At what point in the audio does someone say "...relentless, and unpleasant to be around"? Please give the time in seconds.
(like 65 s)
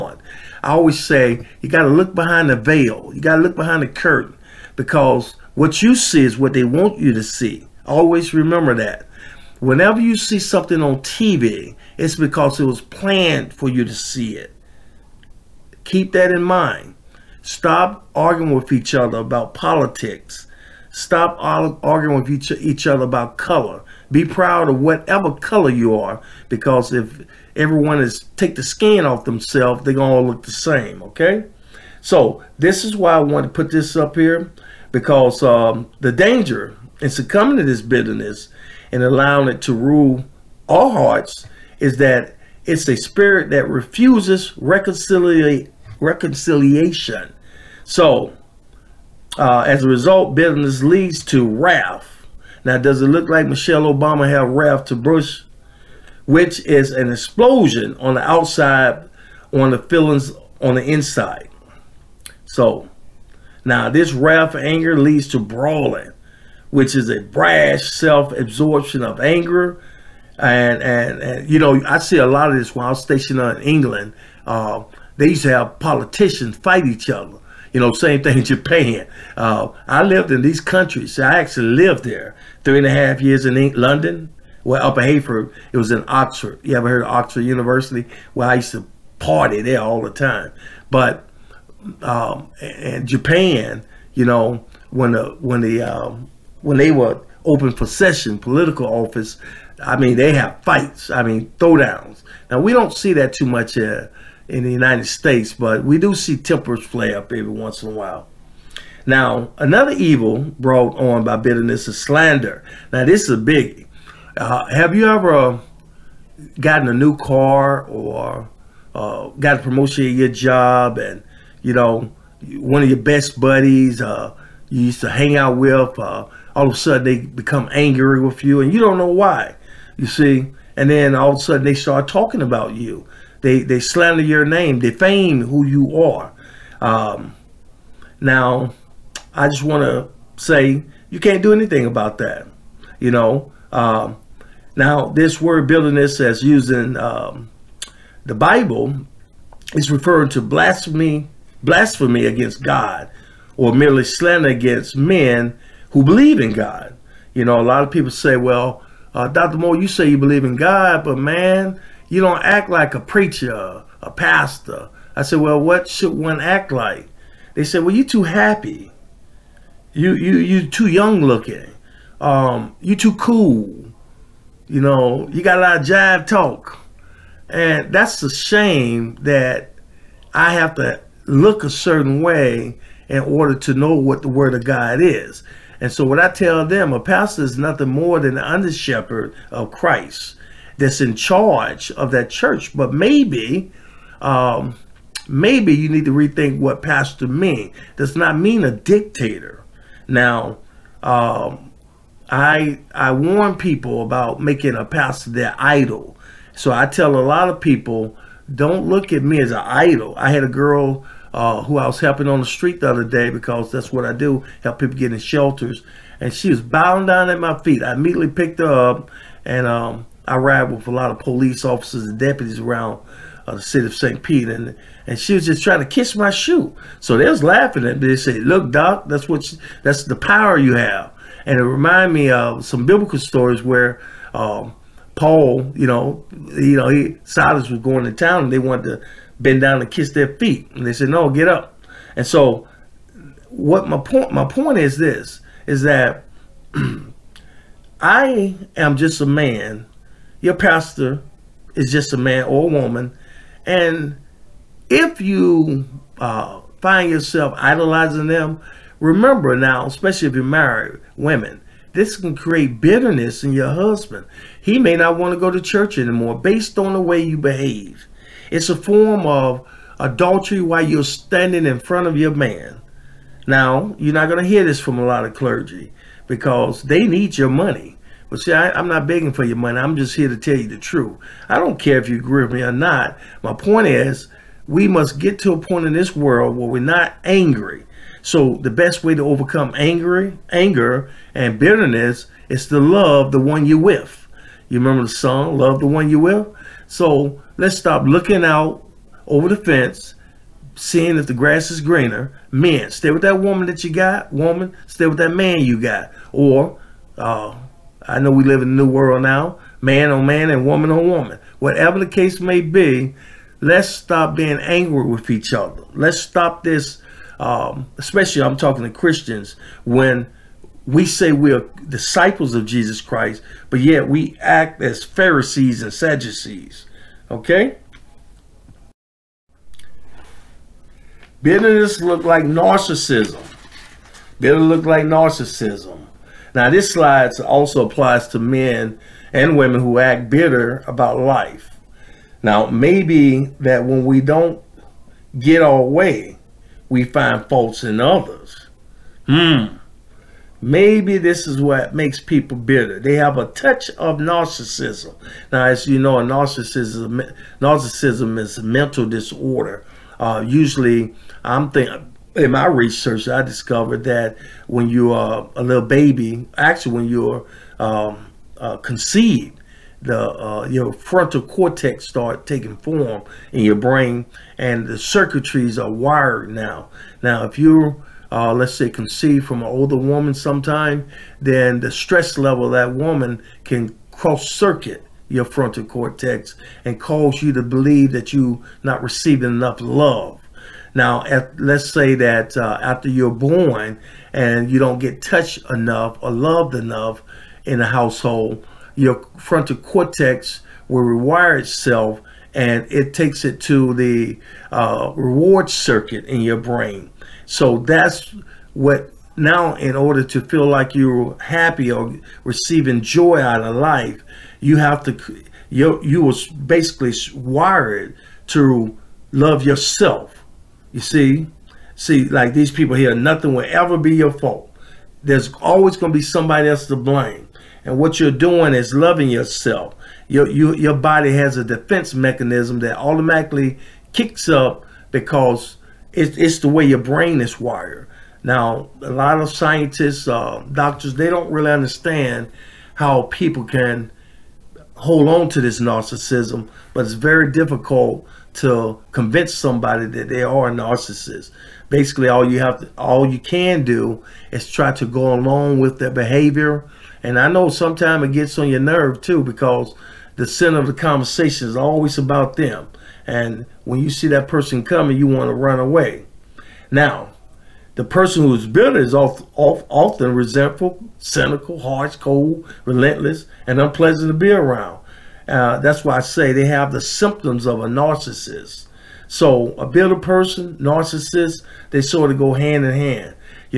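472 s.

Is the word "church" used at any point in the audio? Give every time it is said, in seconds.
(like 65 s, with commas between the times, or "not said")
192 s, 265 s.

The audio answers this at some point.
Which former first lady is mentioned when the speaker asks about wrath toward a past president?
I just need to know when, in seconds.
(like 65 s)
53 s.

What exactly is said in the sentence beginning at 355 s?
Now, as you know, narcissism narcissism is a mental disorder.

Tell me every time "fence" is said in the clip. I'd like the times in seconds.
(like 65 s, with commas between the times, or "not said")
299 s.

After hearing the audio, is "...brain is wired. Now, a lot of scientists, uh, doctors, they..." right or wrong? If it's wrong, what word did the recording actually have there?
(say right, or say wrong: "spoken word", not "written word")
right.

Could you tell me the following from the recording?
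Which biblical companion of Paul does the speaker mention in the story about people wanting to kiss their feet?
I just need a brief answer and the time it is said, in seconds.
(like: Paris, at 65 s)
Silas, at 237 s.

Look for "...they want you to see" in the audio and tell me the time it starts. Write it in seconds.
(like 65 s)
6 s.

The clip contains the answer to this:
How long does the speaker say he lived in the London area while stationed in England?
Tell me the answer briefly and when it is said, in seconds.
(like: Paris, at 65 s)
three and a half years, at 82 s.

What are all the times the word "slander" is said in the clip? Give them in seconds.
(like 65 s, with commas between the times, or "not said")
112 s, 133 s, 154 s.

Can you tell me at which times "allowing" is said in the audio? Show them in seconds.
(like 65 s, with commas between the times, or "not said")
39 s.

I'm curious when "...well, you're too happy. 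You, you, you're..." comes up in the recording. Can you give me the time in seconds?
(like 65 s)
167 s.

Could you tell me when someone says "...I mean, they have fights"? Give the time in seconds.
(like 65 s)
99 s.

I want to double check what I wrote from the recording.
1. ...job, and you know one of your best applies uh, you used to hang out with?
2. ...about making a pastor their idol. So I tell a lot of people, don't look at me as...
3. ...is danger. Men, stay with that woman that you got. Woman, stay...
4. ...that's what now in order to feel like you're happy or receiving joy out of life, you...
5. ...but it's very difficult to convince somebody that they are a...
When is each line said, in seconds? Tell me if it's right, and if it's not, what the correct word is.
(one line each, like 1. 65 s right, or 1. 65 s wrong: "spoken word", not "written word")
1. 120 s wrong: "buddies", not "applies"
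2. 204 s right
3. 301 s wrong: "greener", not "danger"
4. 407 s right
5. 446 s right.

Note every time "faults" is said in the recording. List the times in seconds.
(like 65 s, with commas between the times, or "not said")
347 s, 424 s.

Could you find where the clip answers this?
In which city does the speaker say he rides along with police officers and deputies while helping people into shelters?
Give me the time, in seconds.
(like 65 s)
223 s.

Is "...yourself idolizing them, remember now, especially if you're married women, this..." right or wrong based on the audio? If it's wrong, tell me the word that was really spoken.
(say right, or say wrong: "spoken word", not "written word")
right.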